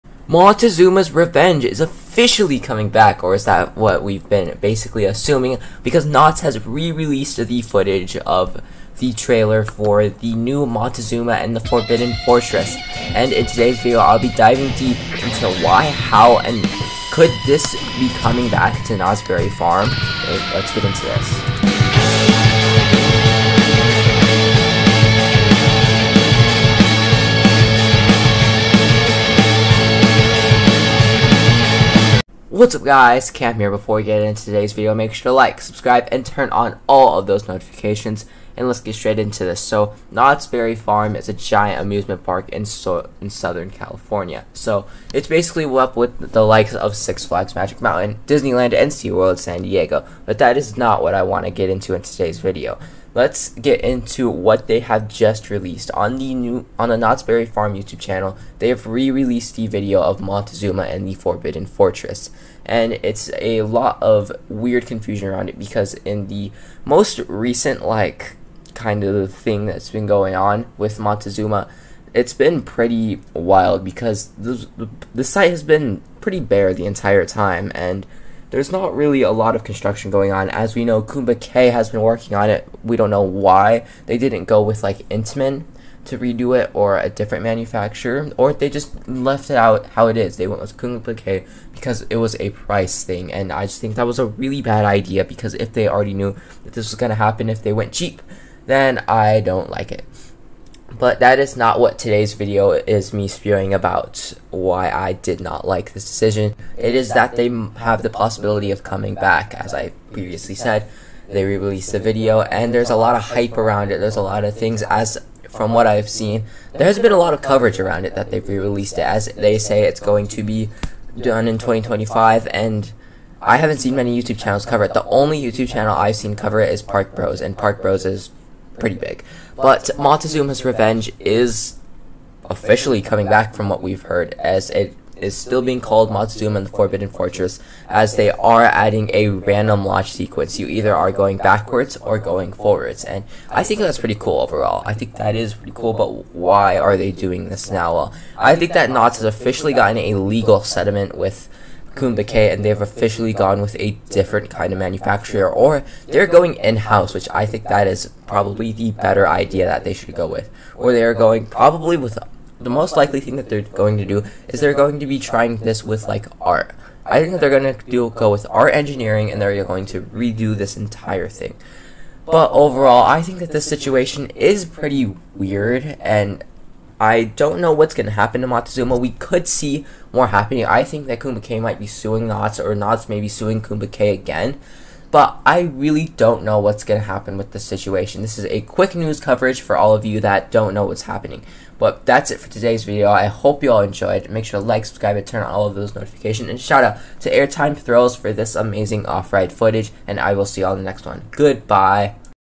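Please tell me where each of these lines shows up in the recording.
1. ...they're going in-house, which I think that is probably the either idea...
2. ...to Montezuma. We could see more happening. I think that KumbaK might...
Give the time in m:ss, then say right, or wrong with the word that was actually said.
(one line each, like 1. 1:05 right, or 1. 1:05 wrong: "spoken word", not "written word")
1. 2:36 wrong: "better", not "either"
2. 2:58 right.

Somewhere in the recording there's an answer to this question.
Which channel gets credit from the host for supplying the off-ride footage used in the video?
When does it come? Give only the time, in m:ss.
3:17.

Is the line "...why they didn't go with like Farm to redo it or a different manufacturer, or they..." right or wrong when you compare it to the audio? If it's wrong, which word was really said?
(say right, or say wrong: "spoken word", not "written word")
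wrong: "Intamin", not "Farm".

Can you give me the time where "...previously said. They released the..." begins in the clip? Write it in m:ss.
1:50.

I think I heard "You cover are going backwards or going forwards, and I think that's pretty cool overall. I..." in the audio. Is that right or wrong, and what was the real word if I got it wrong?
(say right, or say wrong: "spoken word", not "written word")
wrong: "either", not "cover".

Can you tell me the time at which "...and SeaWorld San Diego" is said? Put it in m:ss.
0:48.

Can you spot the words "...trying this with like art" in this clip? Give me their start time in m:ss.
2:45.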